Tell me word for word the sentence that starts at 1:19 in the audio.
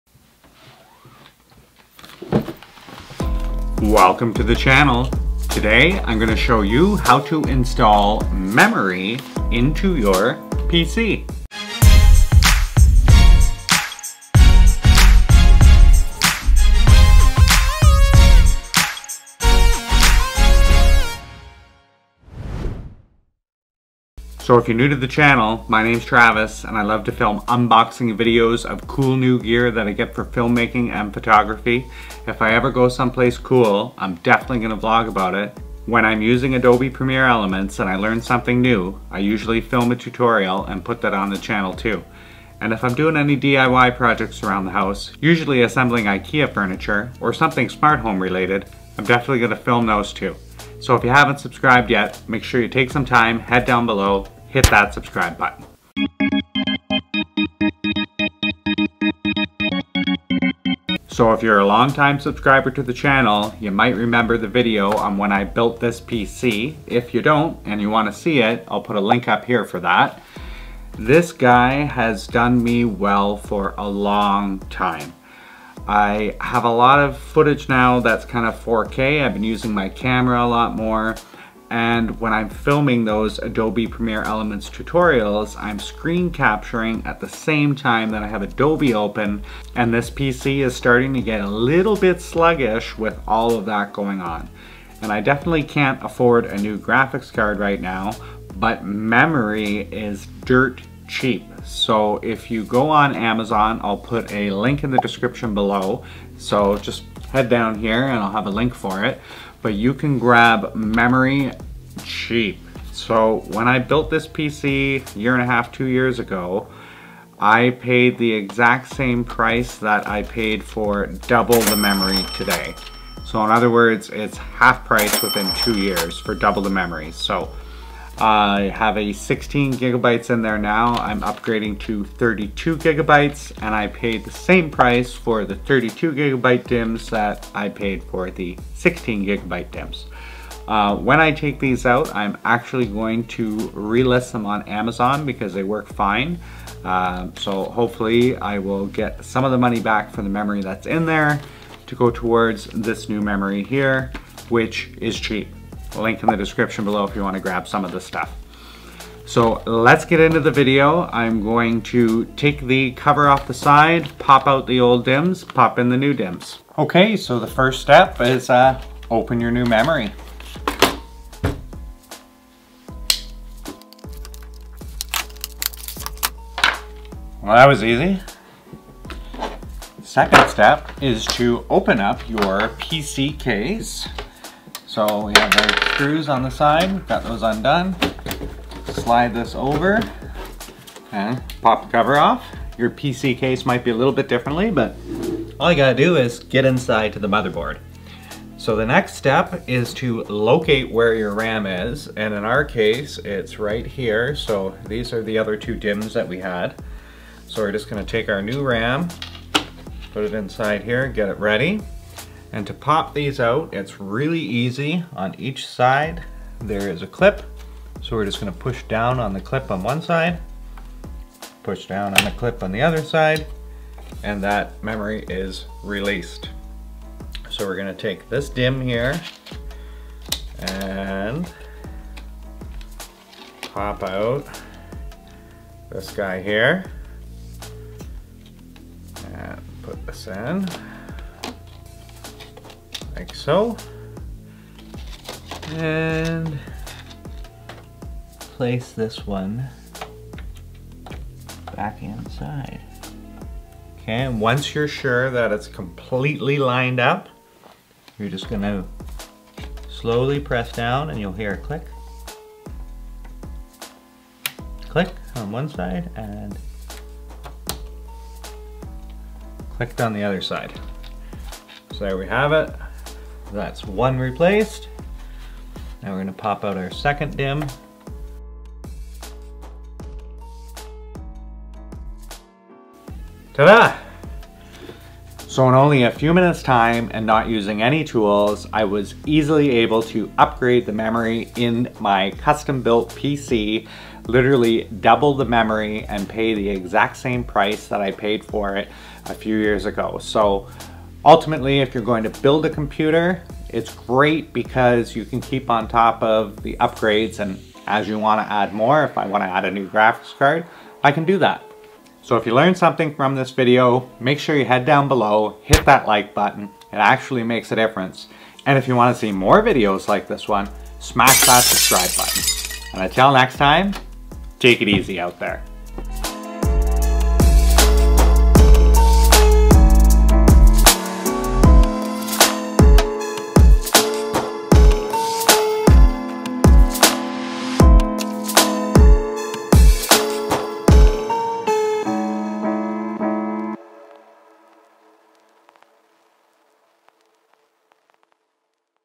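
I've been using my camera a lot more.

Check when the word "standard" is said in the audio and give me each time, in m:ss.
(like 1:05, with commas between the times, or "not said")
not said.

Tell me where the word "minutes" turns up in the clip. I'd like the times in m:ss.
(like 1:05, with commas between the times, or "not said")
4:46.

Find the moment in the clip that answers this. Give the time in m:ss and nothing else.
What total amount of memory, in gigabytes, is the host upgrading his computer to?
2:12.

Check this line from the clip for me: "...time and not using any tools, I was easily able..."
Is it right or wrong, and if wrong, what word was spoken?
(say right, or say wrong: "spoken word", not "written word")
right.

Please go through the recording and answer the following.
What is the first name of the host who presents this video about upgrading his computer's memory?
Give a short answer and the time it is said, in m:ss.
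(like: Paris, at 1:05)
Travis, at 0:26.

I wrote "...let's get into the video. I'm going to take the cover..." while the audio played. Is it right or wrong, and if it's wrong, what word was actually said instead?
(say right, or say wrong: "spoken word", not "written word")
right.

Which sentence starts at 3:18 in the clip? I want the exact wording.
So the next step is to locate where your RAM is, and in our case, it's right here.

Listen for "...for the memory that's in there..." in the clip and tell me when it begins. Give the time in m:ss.
2:30.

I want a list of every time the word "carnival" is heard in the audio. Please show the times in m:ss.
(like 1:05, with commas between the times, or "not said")
not said.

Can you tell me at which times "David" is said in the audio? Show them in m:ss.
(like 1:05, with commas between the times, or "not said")
not said.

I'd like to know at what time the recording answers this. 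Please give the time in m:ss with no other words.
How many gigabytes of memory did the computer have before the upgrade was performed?
2:09.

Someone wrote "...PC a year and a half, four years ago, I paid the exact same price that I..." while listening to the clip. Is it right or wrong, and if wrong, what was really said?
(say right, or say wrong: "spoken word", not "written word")
wrong: "two", not "four".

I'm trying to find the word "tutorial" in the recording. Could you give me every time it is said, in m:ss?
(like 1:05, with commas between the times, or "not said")
0:39, 1:24.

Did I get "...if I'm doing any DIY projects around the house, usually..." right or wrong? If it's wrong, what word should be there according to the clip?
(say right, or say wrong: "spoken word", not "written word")
right.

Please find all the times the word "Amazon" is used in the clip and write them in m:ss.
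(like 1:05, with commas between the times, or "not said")
1:43, 2:24.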